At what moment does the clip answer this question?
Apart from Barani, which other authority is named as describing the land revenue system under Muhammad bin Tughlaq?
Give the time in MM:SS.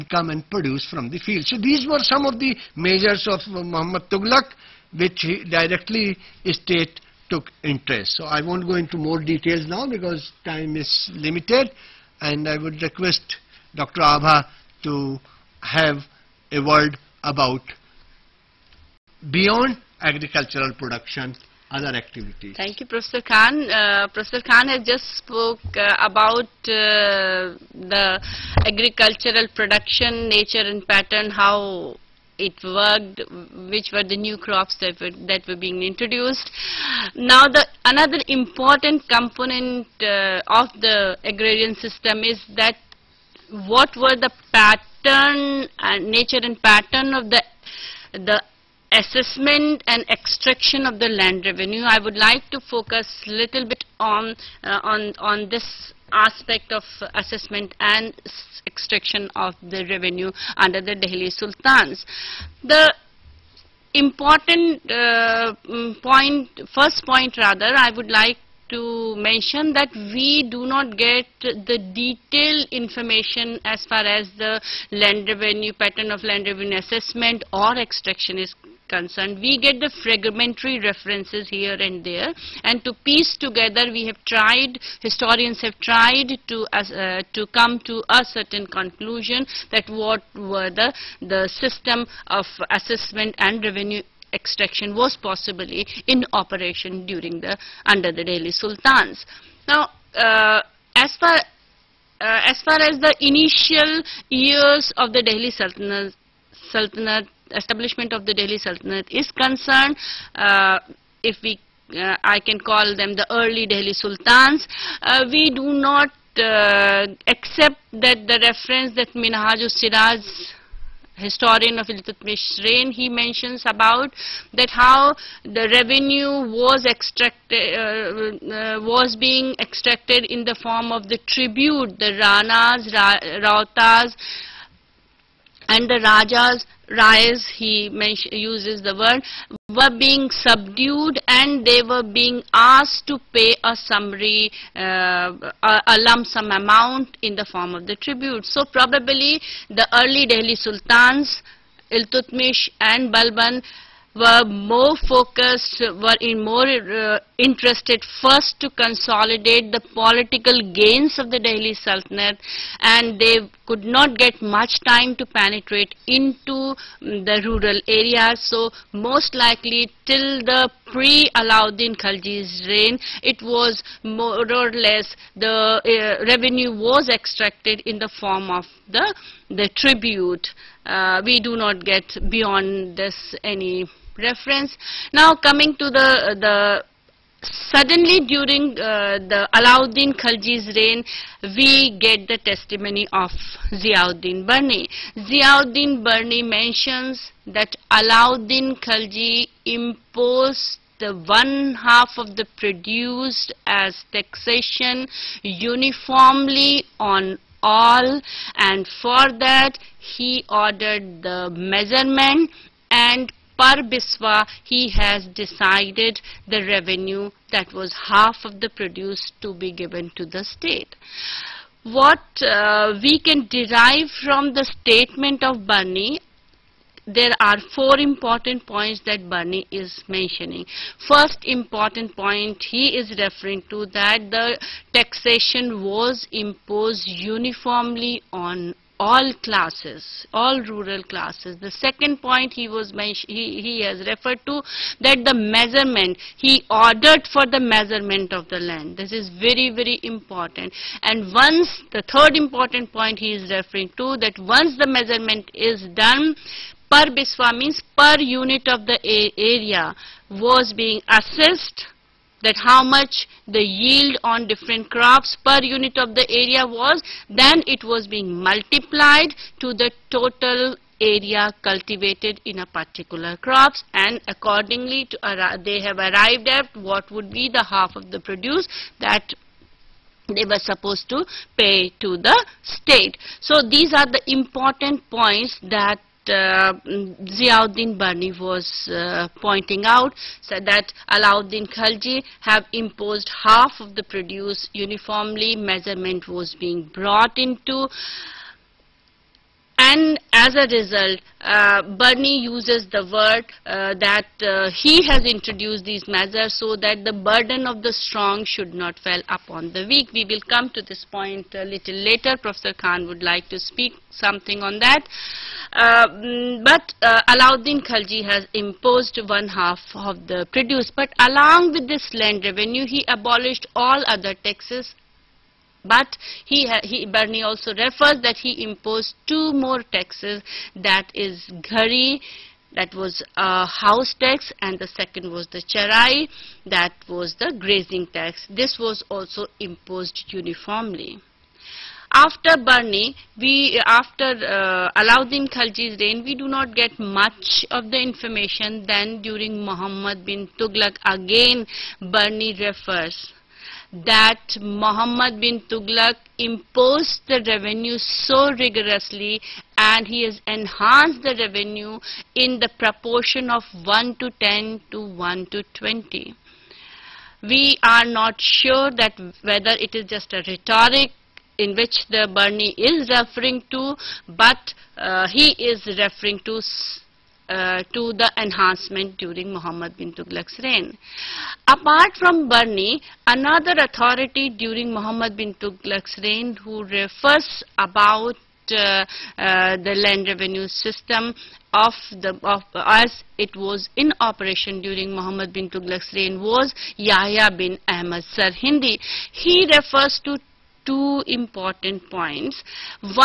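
06:36.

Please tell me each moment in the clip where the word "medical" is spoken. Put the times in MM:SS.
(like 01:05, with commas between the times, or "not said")
not said.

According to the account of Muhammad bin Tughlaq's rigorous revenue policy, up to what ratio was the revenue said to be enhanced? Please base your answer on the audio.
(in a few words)
1 to 20.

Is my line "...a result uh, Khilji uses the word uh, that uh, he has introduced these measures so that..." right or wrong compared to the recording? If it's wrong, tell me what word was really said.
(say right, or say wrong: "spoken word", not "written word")
wrong: "Bernie", not "Khilji".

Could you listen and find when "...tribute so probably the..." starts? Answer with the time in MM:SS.
02:27.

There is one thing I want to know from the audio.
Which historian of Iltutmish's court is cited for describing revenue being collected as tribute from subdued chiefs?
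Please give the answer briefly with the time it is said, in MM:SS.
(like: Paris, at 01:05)
Minhaj Siraj, at 01:59.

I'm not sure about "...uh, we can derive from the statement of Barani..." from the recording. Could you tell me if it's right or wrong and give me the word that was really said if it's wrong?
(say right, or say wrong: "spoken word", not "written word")
right.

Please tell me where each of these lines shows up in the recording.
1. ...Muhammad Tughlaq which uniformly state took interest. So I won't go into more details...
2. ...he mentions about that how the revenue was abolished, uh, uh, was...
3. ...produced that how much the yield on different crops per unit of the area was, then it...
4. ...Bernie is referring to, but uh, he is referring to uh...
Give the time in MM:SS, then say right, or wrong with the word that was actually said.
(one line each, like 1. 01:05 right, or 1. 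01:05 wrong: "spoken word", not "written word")
1. 00:03 wrong: "directly", not "uniformly"
2. 02:02 wrong: "extracted", not "abolished"
3. 04:21 wrong: "assessed", not "produced"
4. 06:12 right.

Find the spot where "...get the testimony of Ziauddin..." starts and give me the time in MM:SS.
03:11.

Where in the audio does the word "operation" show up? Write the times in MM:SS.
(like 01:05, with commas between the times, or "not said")
01:36, 06:34.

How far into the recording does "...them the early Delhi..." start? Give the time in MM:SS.
01:52.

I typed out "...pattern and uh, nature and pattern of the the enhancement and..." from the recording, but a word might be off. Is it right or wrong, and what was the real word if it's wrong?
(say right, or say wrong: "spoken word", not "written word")
wrong: "assessment", not "enhancement".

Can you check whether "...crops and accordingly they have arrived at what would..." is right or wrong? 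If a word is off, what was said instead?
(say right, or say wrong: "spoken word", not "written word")
right.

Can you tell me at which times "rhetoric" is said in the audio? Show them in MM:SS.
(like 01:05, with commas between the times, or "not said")
06:10.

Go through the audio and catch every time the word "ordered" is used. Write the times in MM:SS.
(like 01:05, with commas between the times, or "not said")
03:30, 04:06.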